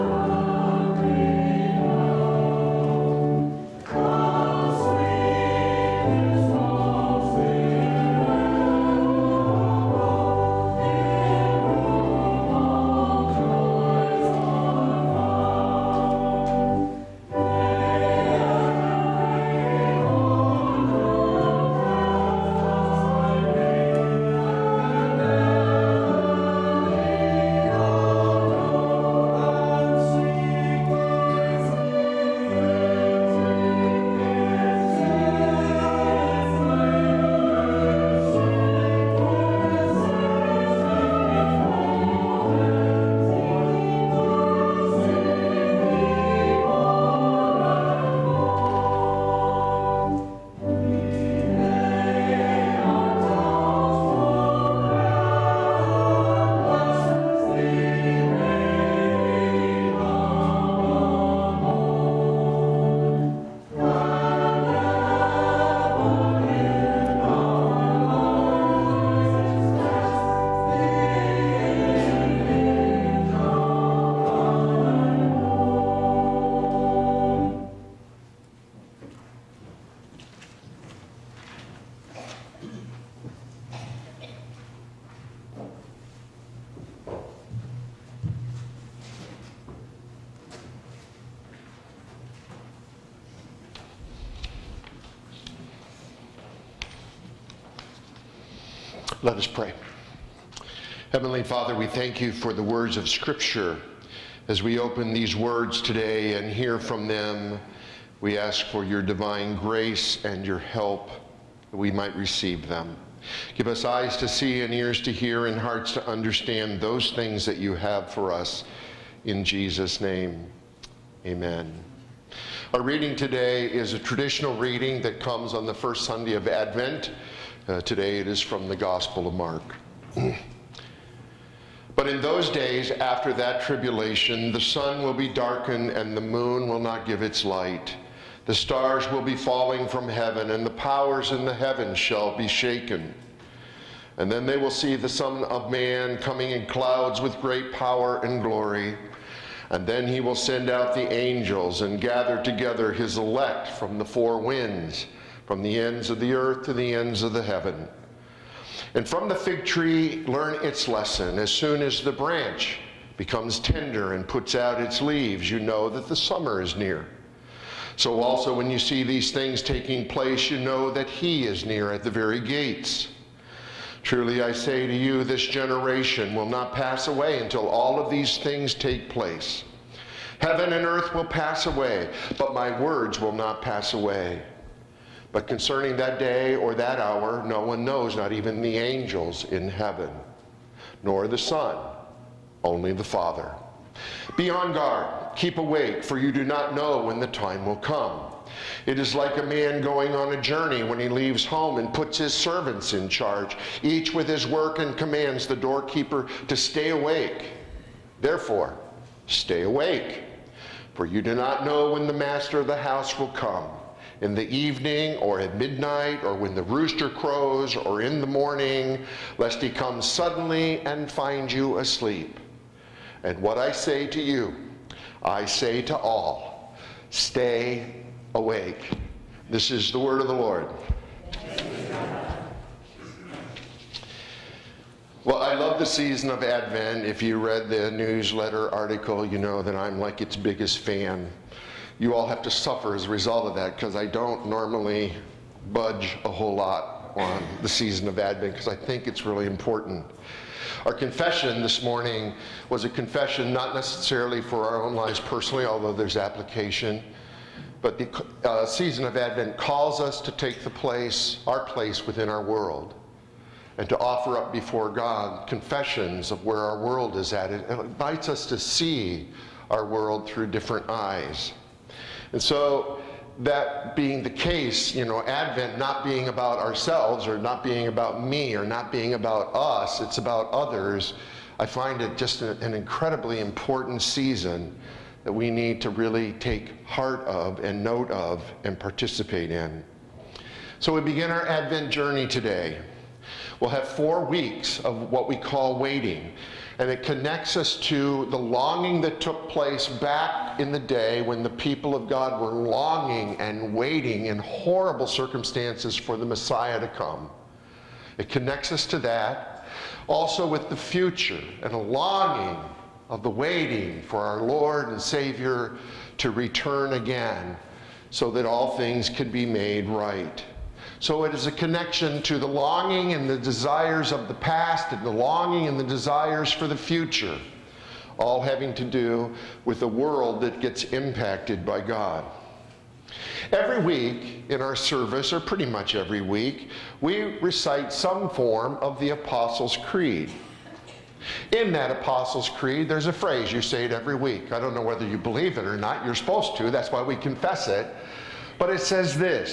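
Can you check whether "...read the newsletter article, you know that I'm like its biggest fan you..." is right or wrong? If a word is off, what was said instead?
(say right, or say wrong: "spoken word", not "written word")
right.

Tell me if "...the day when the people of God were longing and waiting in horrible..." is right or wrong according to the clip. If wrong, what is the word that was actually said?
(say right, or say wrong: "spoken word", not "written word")
right.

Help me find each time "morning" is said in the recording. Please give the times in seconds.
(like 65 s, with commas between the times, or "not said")
218 s, 251 s.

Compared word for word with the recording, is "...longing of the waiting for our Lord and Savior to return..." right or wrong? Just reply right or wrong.
right.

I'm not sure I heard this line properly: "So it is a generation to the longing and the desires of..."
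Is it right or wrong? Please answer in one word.
wrong.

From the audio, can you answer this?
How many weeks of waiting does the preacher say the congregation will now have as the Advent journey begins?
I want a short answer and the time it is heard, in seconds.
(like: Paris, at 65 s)
4, at 293 s.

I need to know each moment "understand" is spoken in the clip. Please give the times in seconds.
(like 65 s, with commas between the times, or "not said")
116 s.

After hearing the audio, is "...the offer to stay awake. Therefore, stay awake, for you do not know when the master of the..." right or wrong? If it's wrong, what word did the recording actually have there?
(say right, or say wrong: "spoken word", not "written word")
wrong: "doorkeeper", not "offer".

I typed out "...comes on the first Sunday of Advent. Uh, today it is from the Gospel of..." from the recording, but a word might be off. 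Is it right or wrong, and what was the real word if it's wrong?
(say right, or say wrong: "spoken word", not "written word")
right.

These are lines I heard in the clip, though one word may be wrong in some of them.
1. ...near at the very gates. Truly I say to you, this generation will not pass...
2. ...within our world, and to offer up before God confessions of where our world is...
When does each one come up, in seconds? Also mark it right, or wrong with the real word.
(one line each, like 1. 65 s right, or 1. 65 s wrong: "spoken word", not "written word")
1. 171 s right
2. 262 s right.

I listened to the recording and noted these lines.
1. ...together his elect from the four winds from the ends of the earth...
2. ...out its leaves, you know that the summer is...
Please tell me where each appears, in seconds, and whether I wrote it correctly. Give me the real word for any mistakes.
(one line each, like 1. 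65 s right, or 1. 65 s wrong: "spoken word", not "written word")
1. 152 s right
2. 164 s right.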